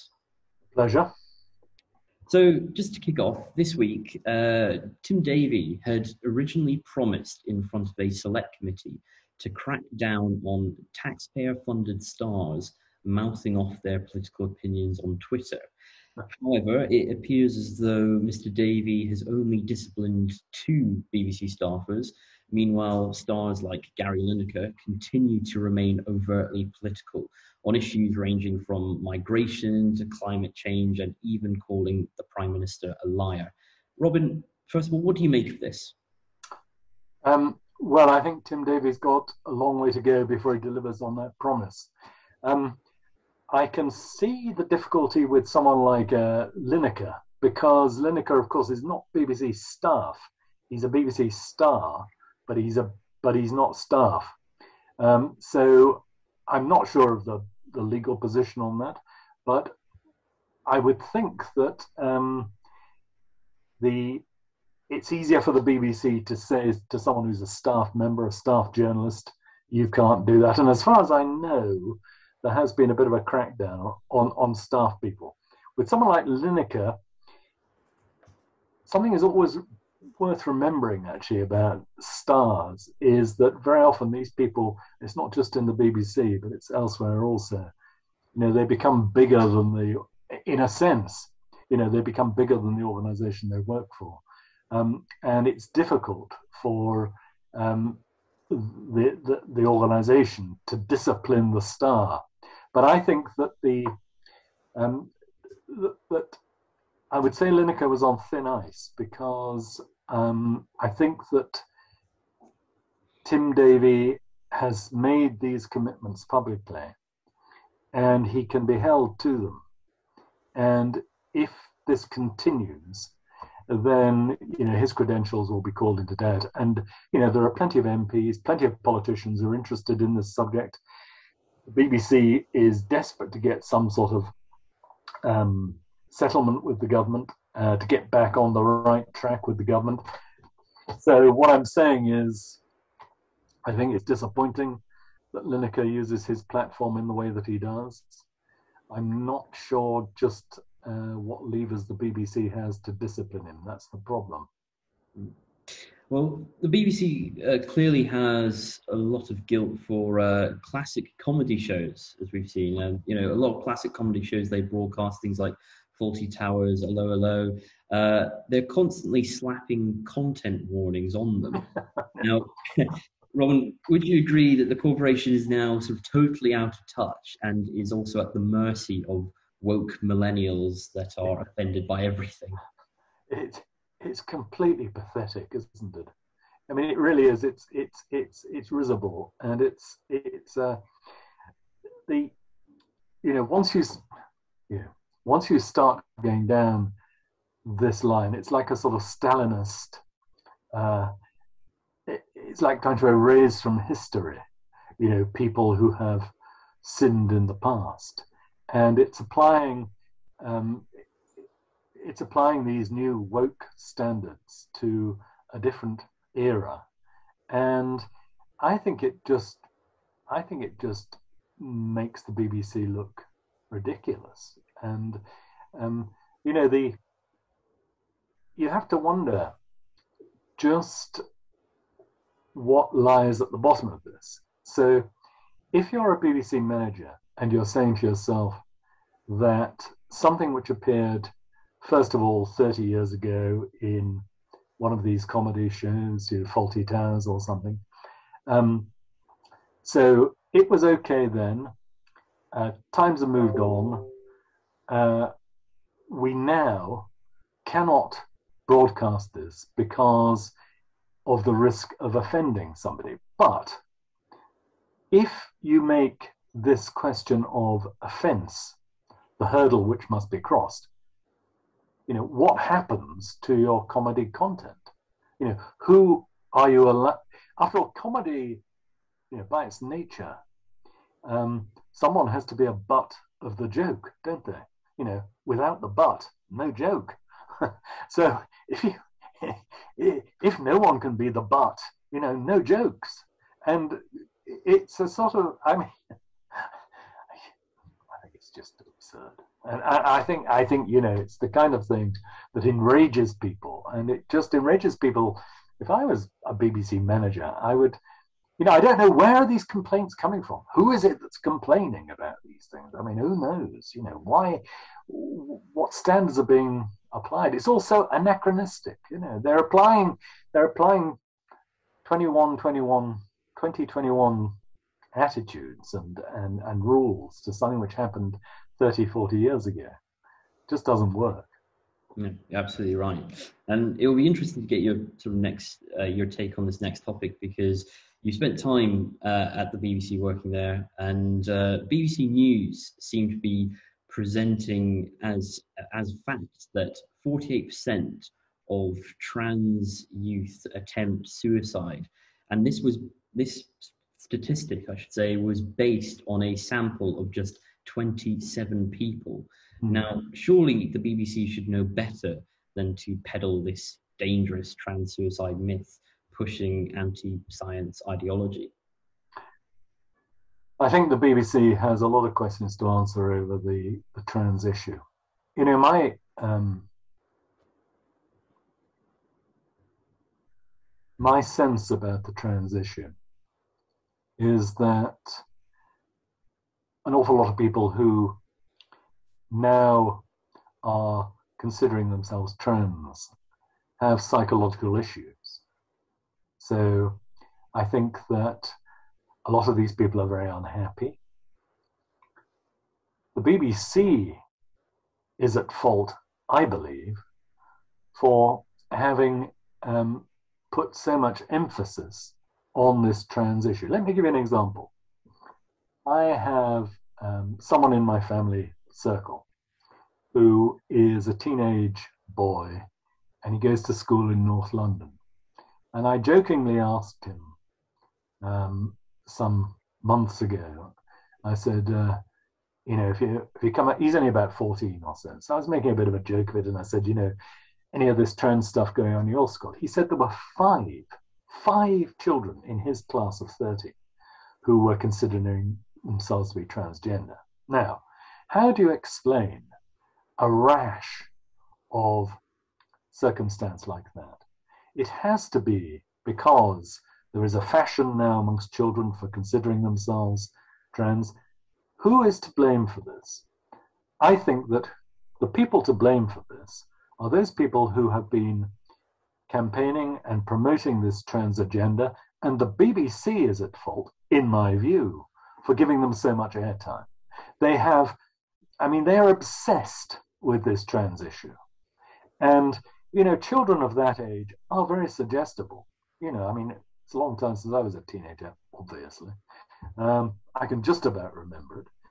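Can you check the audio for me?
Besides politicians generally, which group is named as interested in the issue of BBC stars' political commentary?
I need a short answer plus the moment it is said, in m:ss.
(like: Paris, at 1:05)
MPs, at 2:07.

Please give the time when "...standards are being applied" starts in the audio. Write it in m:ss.
5:15.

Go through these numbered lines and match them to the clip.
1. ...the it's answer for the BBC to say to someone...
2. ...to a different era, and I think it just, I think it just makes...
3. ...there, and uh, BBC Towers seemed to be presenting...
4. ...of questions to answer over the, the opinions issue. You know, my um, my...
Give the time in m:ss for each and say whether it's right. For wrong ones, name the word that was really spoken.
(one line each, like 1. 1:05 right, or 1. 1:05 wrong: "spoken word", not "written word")
1. 1:03 wrong: "easier", not "answer"
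2. 3:34 right
3. 5:40 wrong: "News", not "Towers"
4. 6:12 wrong: "trans", not "opinions".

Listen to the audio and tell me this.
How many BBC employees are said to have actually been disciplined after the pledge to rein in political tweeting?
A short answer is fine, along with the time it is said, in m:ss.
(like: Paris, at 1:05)
2, at 0:20.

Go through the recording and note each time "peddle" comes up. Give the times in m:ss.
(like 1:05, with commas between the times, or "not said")
6:03.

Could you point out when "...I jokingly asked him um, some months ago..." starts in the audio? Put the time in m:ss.
7:06.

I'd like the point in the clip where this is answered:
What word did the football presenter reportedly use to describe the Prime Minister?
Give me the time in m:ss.
0:33.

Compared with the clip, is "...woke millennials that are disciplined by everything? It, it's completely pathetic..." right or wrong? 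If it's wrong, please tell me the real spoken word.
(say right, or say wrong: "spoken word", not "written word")
wrong: "offended", not "disciplined".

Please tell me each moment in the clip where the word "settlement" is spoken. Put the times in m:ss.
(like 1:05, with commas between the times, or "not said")
2:16.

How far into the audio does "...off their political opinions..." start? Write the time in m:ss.
0:13.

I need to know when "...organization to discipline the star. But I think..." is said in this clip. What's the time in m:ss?
1:39.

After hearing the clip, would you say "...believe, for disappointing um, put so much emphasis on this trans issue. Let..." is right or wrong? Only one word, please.
wrong.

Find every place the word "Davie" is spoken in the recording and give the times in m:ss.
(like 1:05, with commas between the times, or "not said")
0:05, 0:18, 0:38, 1:53.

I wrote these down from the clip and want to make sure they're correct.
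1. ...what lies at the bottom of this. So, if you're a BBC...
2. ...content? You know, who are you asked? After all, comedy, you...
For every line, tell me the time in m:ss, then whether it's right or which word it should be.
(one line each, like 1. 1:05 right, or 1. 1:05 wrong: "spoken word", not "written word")
1. 3:52 right
2. 4:34 wrong: "allowed", not "asked".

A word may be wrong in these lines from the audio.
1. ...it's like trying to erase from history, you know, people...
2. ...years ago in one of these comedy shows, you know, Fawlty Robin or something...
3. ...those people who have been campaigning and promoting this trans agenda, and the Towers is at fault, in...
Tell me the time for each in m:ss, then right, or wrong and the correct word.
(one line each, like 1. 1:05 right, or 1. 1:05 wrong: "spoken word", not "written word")
1. 3:22 right
2. 4:02 wrong: "Towers", not "Robin"
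3. 7:47 wrong: "BBC", not "Towers".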